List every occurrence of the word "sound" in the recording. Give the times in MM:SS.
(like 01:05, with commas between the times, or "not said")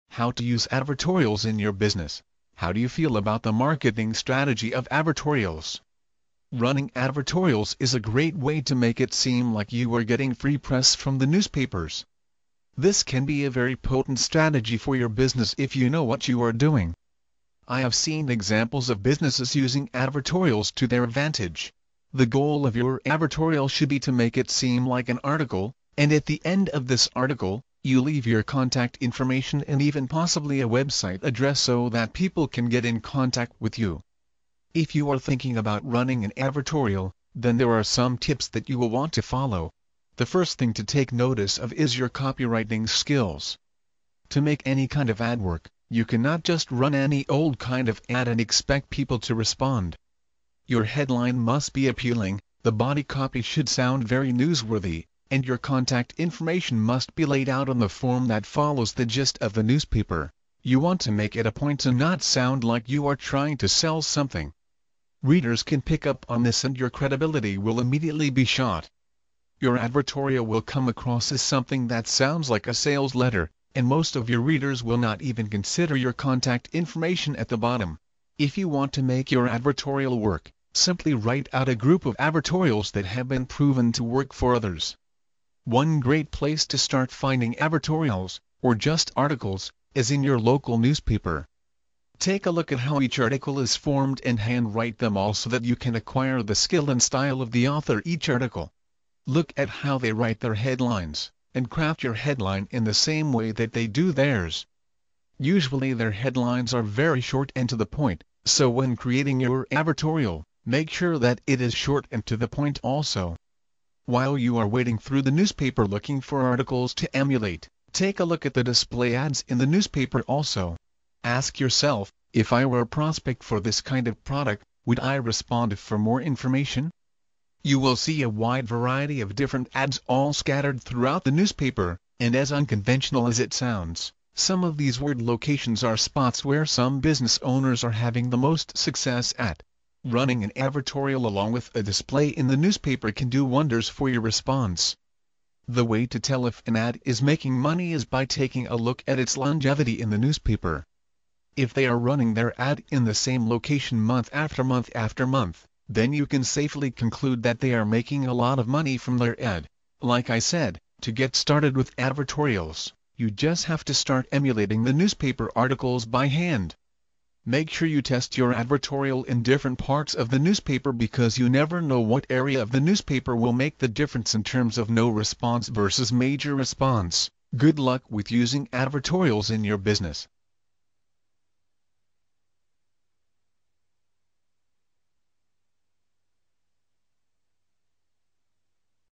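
00:53, 01:02, 01:12, 02:13.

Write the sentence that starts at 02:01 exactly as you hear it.
Ask yourself, if I were a prospect for this kind of product, would I respond for more information?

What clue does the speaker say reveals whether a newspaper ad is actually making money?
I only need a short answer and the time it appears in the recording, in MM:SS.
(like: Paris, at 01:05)
longevity, at 02:29.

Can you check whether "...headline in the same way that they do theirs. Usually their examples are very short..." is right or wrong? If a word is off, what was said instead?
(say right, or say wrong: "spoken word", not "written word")
wrong: "headlines", not "examples".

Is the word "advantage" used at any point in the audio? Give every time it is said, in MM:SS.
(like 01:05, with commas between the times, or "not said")
00:21.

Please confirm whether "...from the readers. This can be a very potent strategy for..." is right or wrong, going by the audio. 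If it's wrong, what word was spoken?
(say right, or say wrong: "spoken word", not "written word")
wrong: "newspapers", not "readers".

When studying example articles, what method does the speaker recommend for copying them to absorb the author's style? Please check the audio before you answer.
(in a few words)
handwrite them.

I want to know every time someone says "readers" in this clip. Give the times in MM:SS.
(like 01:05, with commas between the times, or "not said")
01:05, 01:14.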